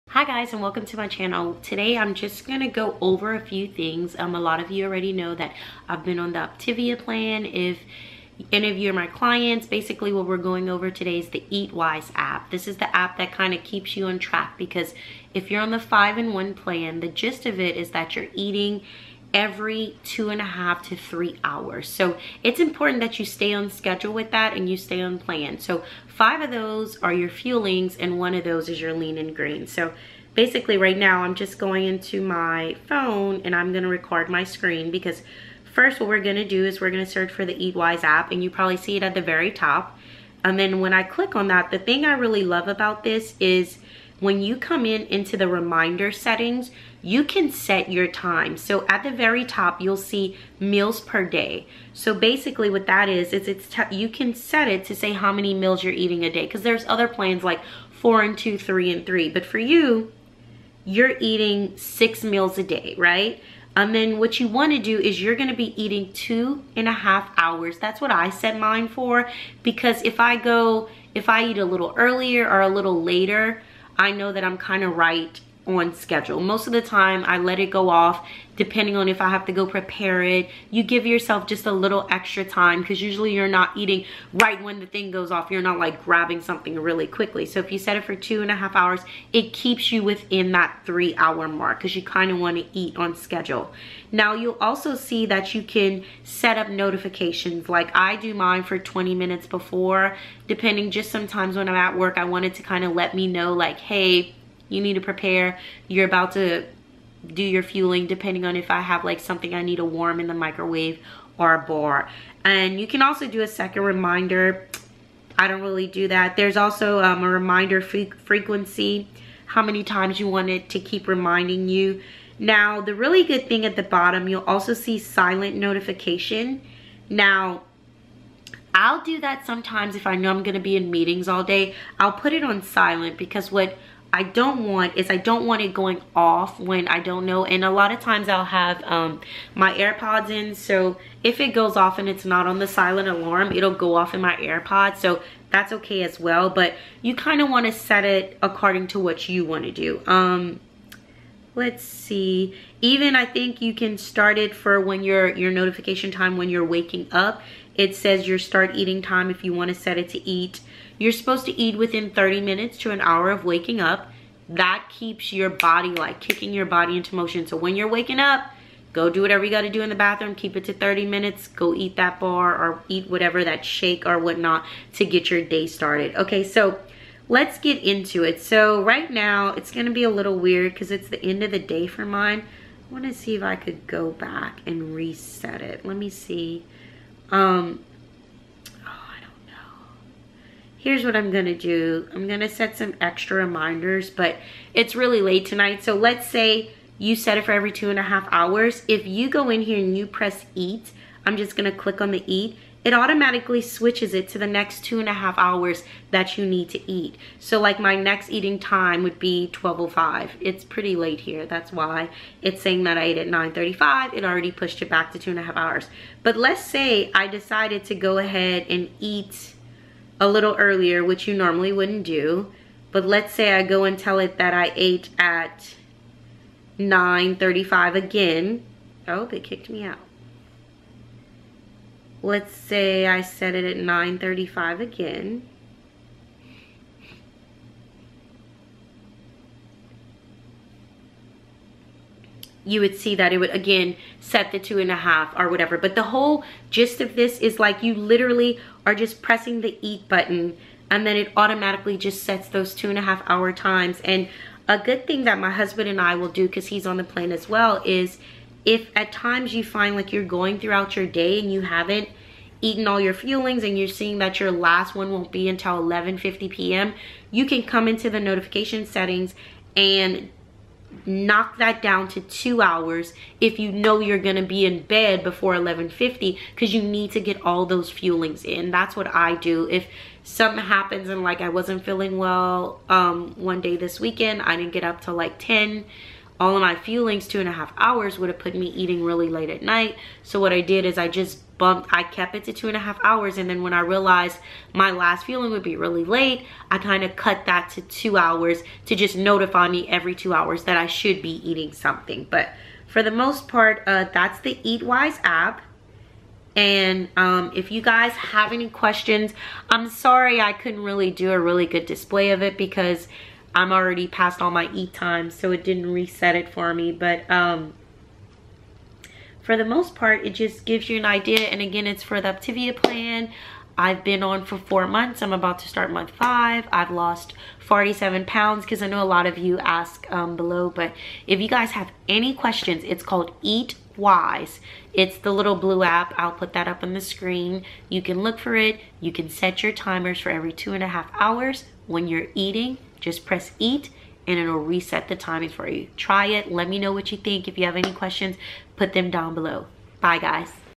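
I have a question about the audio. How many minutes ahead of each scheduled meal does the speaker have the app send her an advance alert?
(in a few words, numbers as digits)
20 minutes.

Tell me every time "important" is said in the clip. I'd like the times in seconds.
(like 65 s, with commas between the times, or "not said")
22 s.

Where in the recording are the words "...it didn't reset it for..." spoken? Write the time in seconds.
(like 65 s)
315 s.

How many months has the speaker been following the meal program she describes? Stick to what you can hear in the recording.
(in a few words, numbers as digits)
4 months.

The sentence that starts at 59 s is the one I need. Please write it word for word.
But for you, you're eating six meals a day, right?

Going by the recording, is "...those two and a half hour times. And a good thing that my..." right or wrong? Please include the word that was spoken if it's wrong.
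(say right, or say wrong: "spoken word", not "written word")
right.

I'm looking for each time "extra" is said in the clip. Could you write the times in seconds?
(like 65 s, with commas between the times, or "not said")
82 s, 192 s.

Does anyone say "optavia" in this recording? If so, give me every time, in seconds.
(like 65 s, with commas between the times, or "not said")
6 s, 322 s.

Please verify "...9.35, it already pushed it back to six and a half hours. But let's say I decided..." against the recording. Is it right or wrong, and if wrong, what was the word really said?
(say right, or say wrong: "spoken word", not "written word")
wrong: "two", not "six".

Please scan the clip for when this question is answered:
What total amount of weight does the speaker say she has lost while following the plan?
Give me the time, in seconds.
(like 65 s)
327 s.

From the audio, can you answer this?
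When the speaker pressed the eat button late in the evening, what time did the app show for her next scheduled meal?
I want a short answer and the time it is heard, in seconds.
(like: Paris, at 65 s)
12:05, at 209 s.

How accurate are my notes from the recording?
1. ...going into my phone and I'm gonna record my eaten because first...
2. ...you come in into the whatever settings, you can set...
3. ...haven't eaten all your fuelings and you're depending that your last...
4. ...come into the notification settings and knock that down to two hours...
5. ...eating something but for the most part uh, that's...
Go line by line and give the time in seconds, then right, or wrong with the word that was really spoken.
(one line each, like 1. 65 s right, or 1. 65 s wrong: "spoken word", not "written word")
1. 31 s wrong: "screen", not "eaten"
2. 44 s wrong: "reminder", not "whatever"
3. 261 s wrong: "seeing", not "depending"
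4. 267 s right
5. 301 s right.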